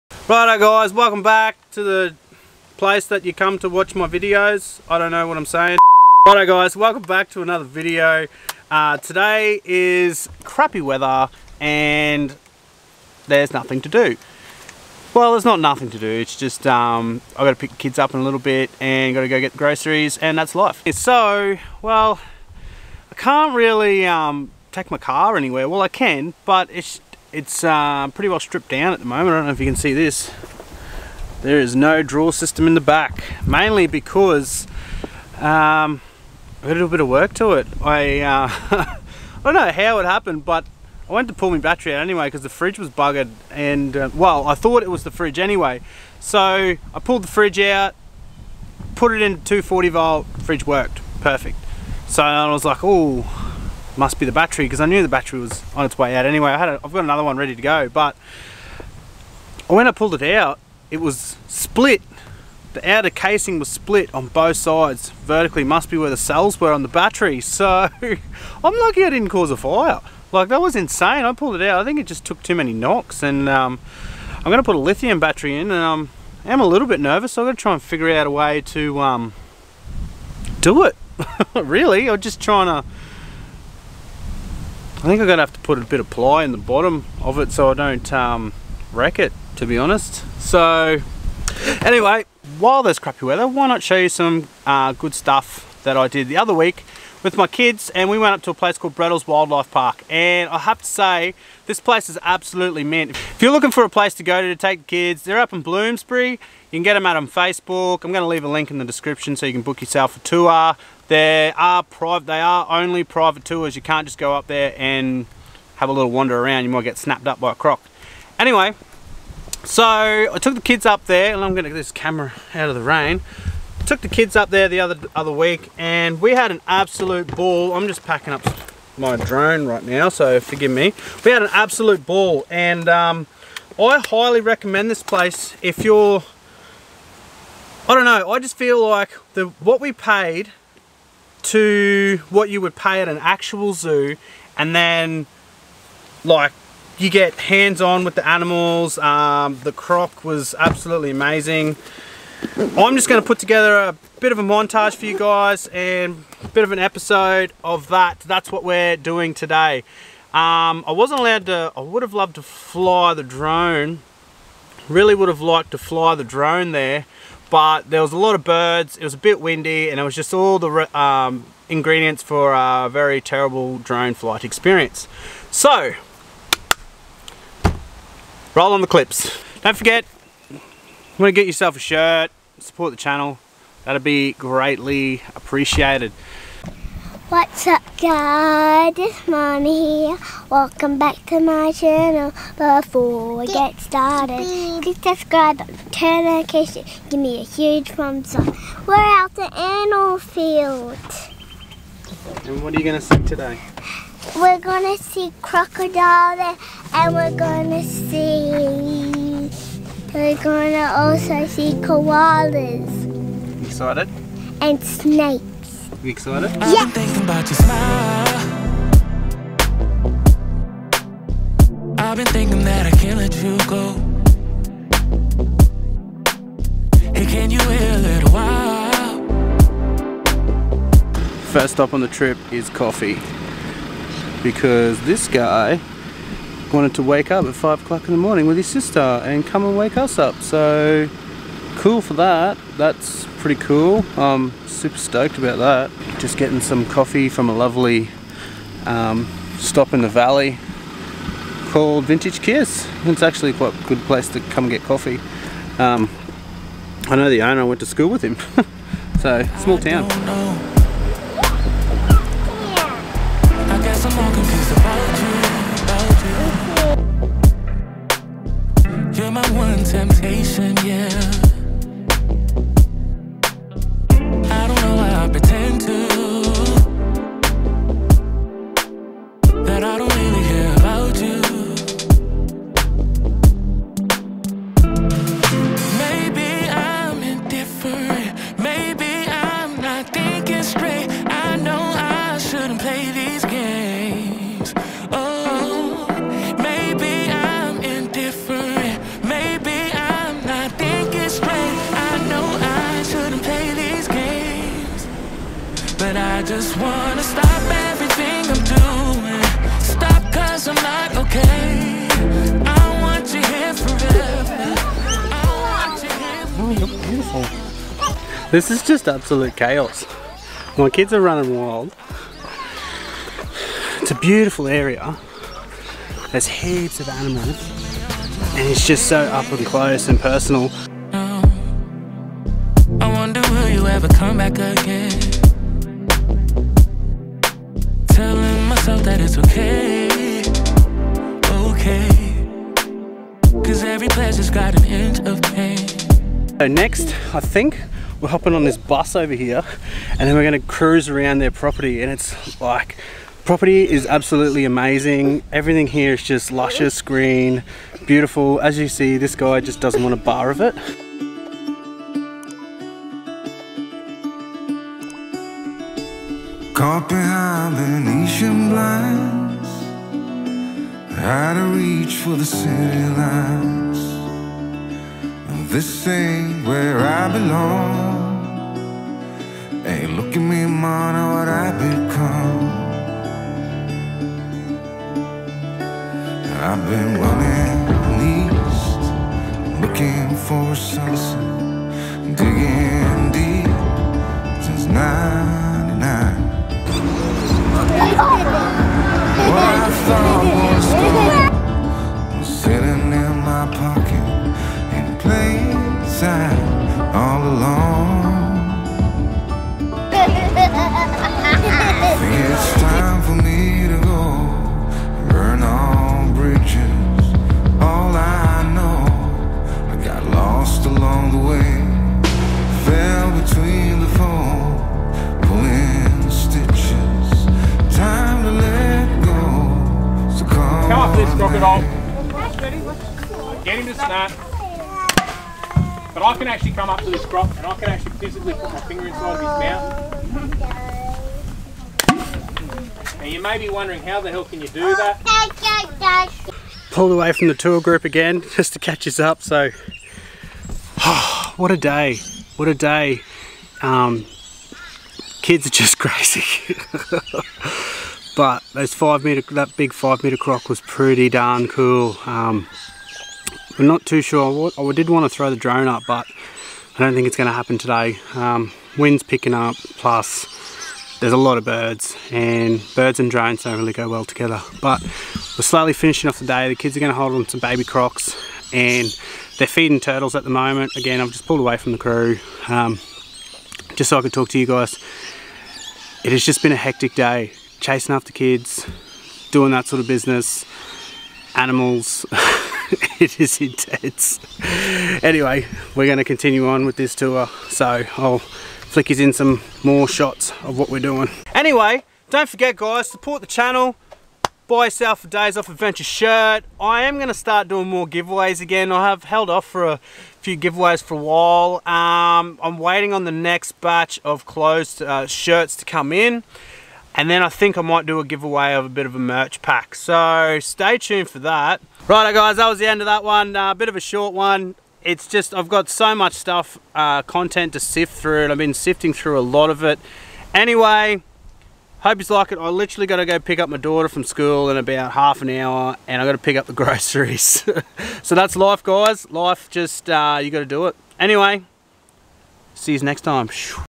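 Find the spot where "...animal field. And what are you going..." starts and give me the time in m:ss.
3:19.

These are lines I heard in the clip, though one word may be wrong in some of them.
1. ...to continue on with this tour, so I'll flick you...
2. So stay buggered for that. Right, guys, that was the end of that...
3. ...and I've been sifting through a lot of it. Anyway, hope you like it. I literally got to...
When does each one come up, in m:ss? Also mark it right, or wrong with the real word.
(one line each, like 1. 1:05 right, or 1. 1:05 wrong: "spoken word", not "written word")
1. 8:16 right
2. 8:39 wrong: "tuned", not "buggered"
3. 8:48 right.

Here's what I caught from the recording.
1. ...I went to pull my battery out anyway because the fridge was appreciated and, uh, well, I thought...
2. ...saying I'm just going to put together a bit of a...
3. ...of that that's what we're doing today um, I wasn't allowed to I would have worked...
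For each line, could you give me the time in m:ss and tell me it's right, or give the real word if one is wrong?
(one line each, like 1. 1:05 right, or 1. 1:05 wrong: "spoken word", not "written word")
1. 0:41 wrong: "buggered", not "appreciated"
2. 2:31 wrong: "amazing", not "saying"
3. 2:37 wrong: "loved", not "worked".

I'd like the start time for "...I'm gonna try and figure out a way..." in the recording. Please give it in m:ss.
1:17.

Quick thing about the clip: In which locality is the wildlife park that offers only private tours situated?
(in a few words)
Bloomsbury.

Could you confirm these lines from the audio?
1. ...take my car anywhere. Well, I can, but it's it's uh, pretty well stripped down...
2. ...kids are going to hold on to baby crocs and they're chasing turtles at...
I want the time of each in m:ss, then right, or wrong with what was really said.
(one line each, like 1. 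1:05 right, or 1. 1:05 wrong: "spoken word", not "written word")
1. 0:24 right
2. 7:56 wrong: "feeding", not "chasing".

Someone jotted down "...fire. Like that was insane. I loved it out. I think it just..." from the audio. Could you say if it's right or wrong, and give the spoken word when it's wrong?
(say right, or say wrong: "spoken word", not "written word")
wrong: "pulled", not "loved".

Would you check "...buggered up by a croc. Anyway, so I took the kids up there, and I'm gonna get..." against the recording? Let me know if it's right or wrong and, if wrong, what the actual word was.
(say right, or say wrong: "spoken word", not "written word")
wrong: "snapped", not "buggered".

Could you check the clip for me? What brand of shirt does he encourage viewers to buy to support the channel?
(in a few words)
Days Off Adventure.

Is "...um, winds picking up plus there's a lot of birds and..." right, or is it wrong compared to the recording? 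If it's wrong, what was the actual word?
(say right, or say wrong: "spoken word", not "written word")
right.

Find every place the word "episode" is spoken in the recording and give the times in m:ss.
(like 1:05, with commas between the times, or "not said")
2:36.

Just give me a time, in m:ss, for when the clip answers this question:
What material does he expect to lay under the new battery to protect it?
1:26.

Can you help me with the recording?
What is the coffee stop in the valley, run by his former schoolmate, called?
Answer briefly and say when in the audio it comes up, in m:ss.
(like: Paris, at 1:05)
Vintage Kiss, at 4:12.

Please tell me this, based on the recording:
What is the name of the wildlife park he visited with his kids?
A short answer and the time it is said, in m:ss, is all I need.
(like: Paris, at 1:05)
Bredls Wildlife Park, at 1:38.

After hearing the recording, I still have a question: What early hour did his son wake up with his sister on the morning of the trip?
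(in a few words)
5 o'clock.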